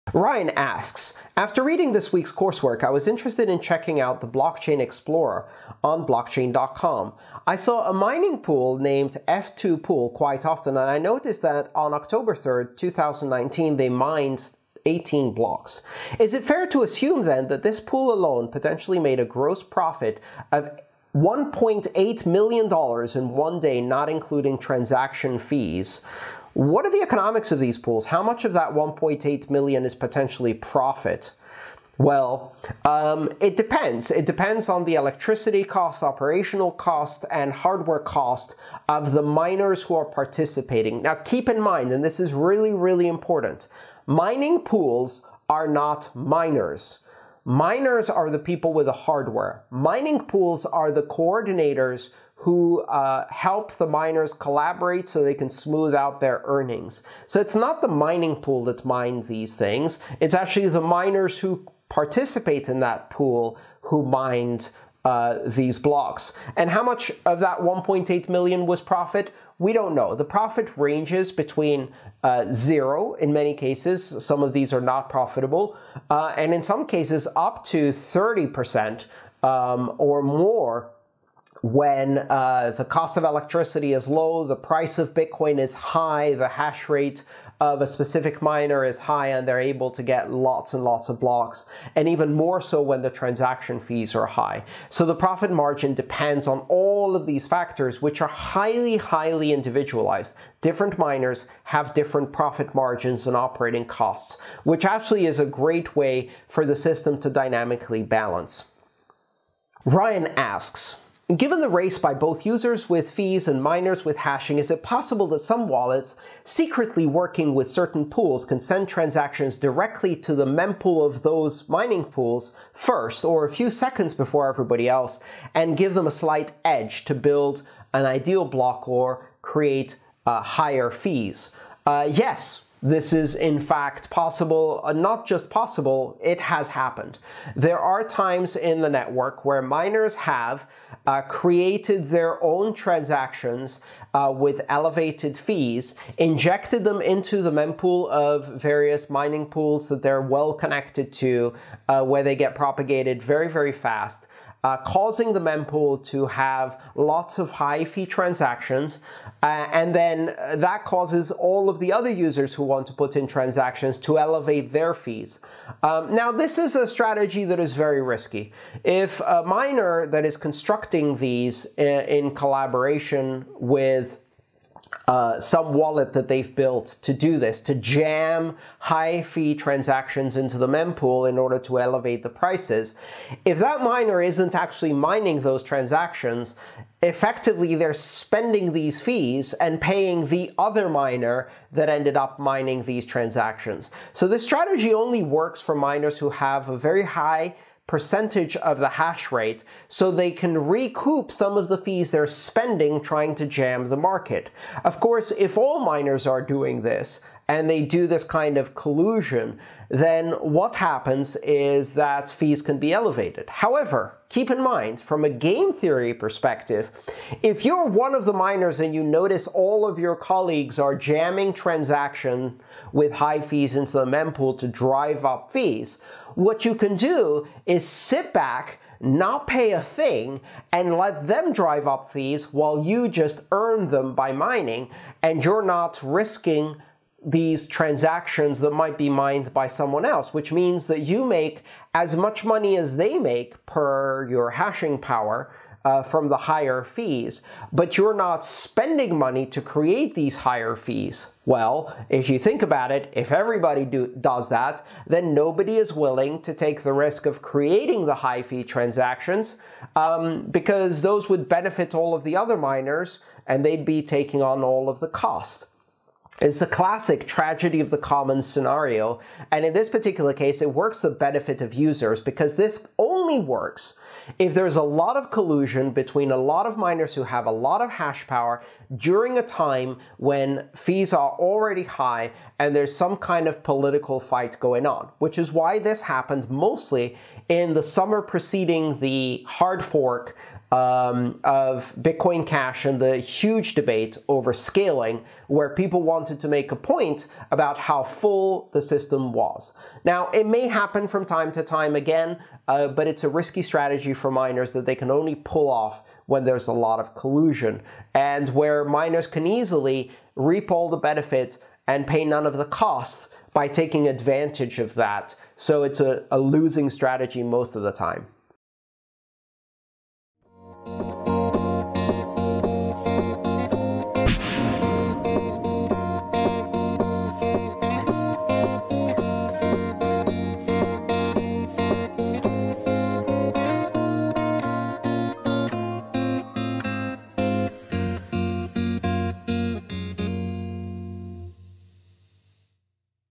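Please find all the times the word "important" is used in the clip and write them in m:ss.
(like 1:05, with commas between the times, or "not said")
0:43.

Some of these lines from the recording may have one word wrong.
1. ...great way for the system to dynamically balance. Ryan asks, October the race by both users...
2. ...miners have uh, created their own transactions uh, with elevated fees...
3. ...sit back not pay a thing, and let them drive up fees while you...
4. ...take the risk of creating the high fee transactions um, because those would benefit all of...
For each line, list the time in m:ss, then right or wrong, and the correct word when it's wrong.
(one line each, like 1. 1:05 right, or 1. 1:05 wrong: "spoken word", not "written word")
1. 1:45 wrong: "Given", not "October"
2. 2:19 right
3. 3:47 right
4. 4:16 right.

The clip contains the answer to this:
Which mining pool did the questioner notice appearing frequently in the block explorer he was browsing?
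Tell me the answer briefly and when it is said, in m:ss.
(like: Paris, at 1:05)
F2 Pool, at 0:09.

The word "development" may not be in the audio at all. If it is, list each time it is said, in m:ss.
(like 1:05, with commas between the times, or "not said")
not said.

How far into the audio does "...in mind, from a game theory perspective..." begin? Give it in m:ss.
3:34.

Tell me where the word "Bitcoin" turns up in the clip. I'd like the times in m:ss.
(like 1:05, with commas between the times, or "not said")
1:25, 4:52.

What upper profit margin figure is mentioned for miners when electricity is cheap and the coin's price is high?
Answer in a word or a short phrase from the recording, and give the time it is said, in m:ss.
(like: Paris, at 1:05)
30%, at 1:17.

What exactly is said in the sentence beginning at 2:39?
Uh, and then uh, that causes all of the other users who want to put in transactions to elevate their fees.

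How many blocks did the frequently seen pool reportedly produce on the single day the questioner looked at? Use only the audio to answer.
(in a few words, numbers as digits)
18.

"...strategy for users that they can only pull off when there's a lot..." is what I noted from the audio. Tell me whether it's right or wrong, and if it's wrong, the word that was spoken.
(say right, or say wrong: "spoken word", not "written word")
wrong: "miners", not "users".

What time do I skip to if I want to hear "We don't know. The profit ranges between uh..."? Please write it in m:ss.
1:09.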